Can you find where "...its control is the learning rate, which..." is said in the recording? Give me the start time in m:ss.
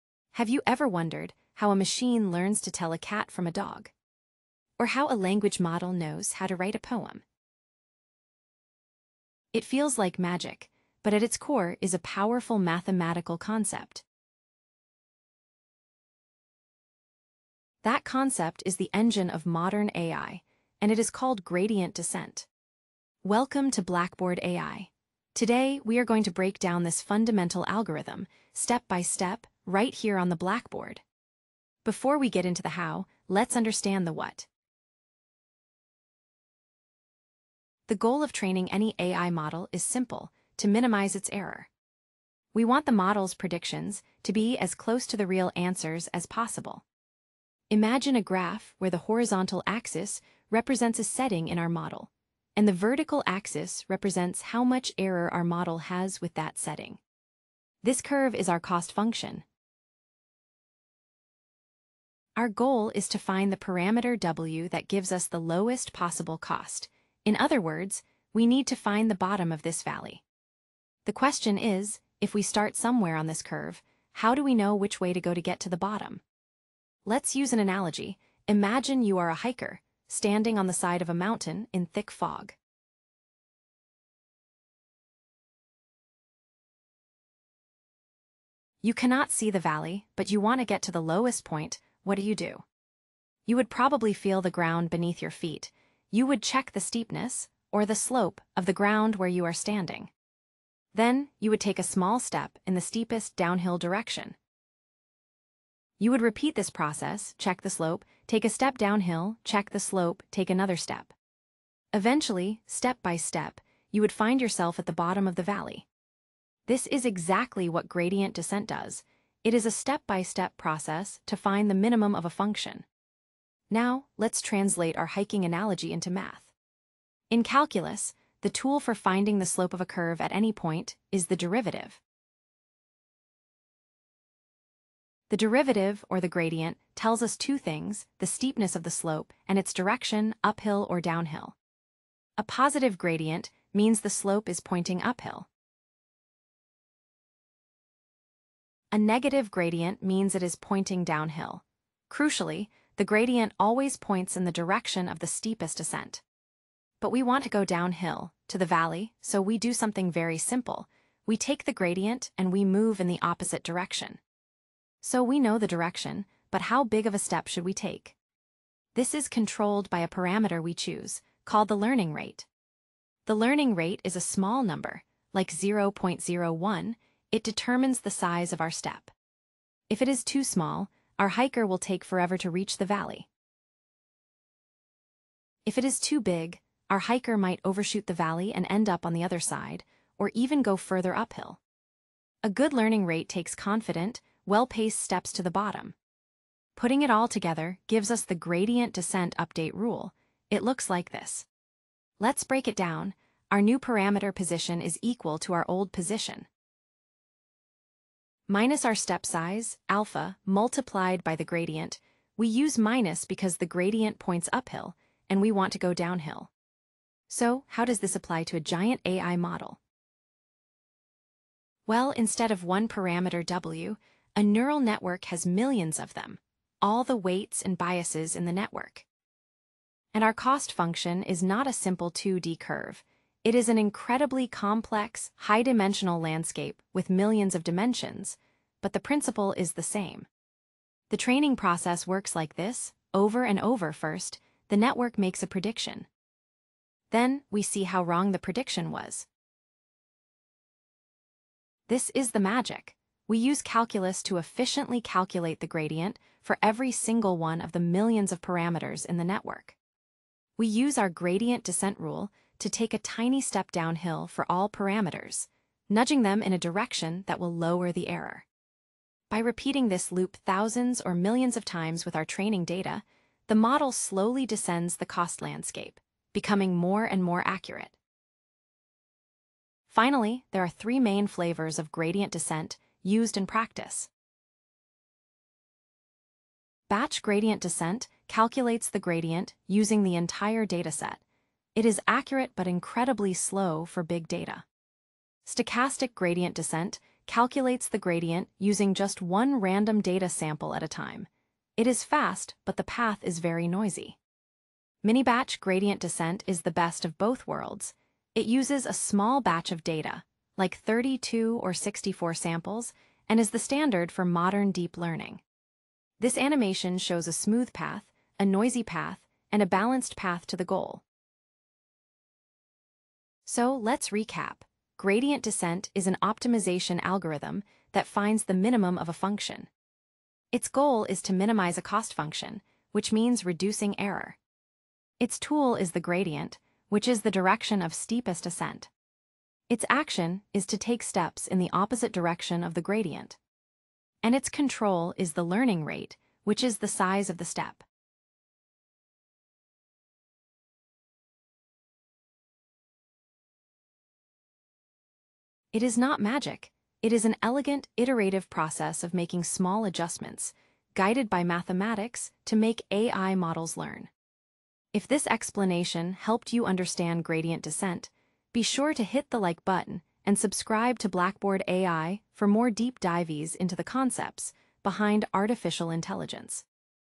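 5:44.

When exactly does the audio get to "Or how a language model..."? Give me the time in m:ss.
0:04.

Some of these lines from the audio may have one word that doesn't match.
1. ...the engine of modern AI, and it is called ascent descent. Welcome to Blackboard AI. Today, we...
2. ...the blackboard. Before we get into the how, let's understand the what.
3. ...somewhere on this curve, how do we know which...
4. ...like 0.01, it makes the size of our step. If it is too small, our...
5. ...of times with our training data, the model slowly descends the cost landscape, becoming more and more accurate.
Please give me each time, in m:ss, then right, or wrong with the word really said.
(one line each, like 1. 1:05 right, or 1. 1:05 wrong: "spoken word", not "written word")
1. 0:18 wrong: "gradient", not "ascent"
2. 0:30 right
3. 1:12 right
4. 2:55 wrong: "determines", not "makes"
5. 4:31 right.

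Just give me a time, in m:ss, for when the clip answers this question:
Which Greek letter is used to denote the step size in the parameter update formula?
3:29.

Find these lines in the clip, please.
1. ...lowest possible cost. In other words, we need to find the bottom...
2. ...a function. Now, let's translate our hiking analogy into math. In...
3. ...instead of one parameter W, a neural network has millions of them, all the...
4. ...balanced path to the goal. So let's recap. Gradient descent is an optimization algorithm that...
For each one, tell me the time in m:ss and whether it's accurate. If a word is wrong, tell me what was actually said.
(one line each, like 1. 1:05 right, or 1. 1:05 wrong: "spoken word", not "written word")
1. 1:05 right
2. 2:02 right
3. 3:42 right
4. 5:19 right.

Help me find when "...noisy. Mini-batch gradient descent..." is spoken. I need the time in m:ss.
5:03.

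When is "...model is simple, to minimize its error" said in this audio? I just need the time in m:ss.
0:39.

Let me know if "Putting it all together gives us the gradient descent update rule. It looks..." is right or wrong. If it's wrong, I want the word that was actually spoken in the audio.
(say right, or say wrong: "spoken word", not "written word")
right.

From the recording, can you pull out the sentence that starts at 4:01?
The training process works like this, over and over first, the network makes a prediction.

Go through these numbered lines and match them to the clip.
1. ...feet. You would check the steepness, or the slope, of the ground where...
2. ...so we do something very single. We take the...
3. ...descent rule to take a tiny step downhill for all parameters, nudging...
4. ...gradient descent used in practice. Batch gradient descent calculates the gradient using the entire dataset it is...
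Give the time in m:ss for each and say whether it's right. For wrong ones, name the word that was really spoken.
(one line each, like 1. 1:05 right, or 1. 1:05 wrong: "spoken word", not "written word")
1. 1:35 right
2. 2:39 wrong: "simple", not "single"
3. 4:21 right
4. 4:41 right.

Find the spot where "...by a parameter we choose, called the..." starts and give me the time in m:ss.
2:49.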